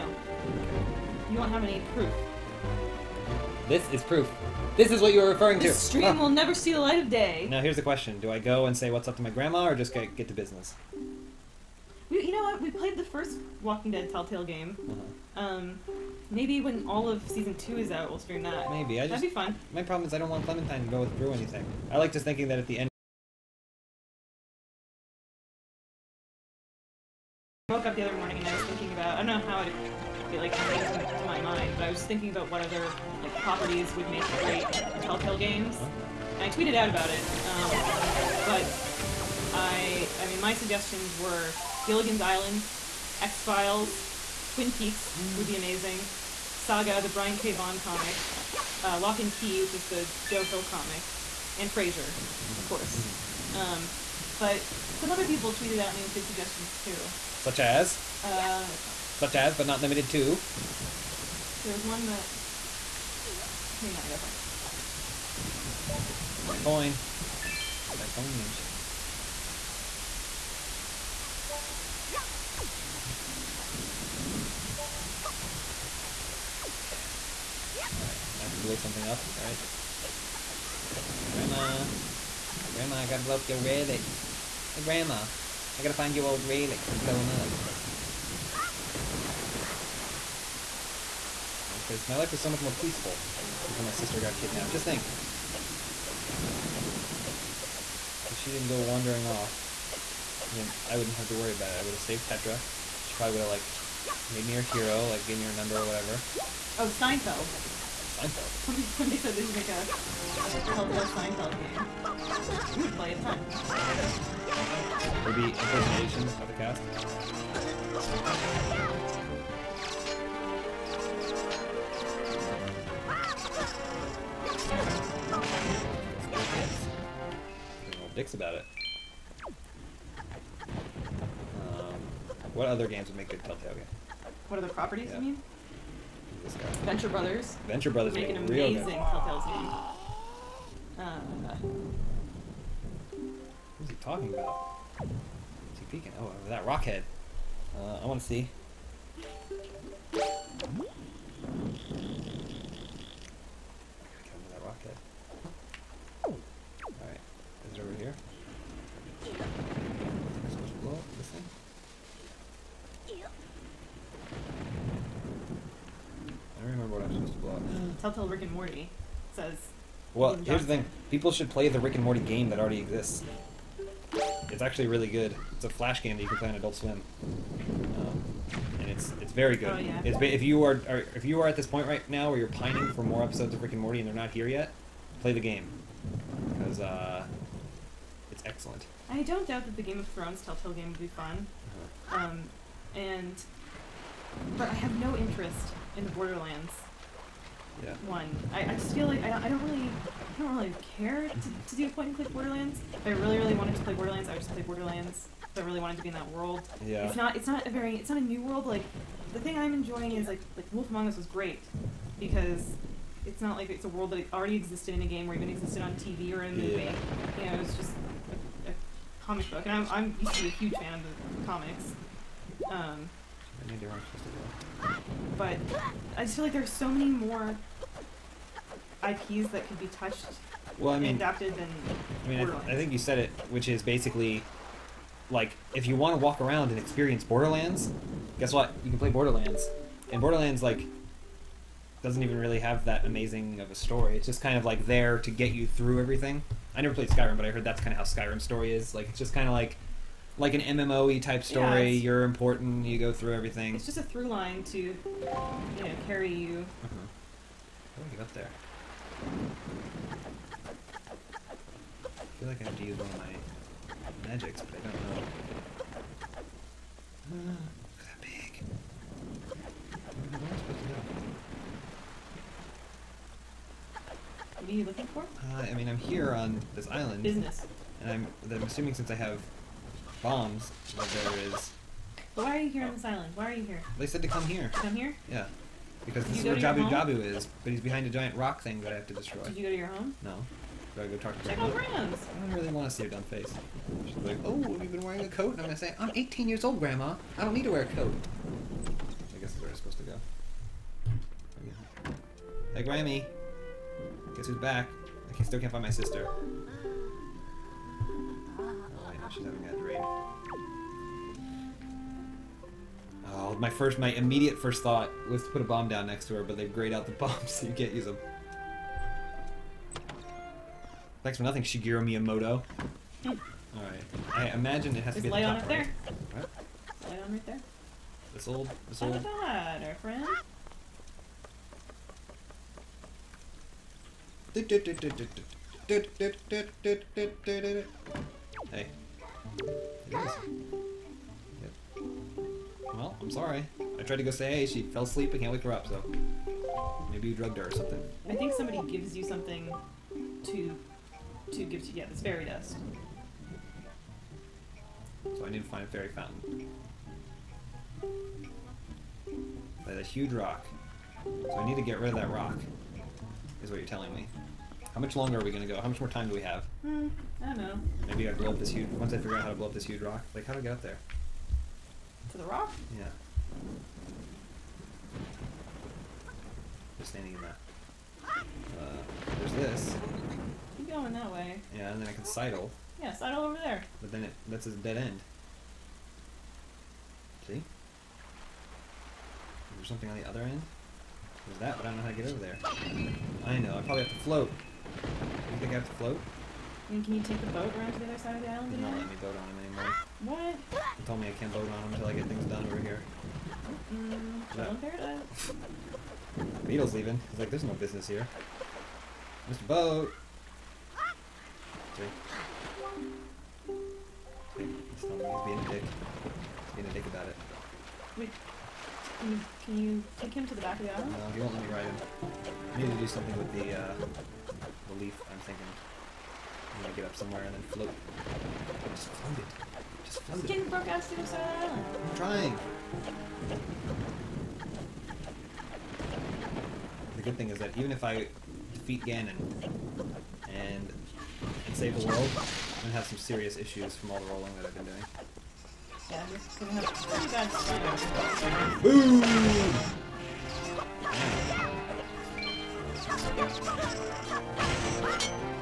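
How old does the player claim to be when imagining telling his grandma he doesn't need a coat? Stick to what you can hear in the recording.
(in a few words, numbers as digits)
18.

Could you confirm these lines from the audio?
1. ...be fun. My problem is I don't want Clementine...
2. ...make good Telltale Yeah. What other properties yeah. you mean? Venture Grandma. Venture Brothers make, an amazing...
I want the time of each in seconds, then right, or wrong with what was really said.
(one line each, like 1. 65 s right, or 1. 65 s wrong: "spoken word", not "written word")
1. 19 s right
2. 133 s wrong: "Brothers", not "Grandma".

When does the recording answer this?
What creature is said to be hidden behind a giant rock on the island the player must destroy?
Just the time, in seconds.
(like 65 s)
286 s.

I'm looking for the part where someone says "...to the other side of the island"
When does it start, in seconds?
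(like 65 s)
397 s.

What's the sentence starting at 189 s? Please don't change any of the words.
I don't doubt that the Game of Thrones Telltale game would be fun.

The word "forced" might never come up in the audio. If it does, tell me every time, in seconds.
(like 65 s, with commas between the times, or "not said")
not said.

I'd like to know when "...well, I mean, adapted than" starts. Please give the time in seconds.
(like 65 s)
230 s.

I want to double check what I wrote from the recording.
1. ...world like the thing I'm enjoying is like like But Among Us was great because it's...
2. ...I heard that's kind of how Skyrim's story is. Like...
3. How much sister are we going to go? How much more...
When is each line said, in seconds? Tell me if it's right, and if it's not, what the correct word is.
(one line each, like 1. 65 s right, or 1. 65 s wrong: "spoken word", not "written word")
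1. 208 s wrong: "Wolf", not "But"
2. 247 s right
3. 364 s wrong: "longer", not "sister".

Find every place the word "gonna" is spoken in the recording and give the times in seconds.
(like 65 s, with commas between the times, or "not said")
295 s, 426 s, 442 s.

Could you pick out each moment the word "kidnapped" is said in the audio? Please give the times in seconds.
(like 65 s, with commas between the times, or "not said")
94 s.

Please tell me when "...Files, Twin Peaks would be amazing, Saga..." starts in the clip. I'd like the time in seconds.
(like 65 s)
43 s.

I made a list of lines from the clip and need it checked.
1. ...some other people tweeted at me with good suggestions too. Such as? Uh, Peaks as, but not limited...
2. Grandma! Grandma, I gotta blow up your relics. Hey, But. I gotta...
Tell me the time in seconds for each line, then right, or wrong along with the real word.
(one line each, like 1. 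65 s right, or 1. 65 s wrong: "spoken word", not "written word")
1. 54 s wrong: "Such", not "Peaks"
2. 81 s wrong: "Grandma", not "But".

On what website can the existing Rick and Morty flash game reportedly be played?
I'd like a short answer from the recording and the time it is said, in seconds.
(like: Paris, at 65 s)
Adult Swim, at 176 s.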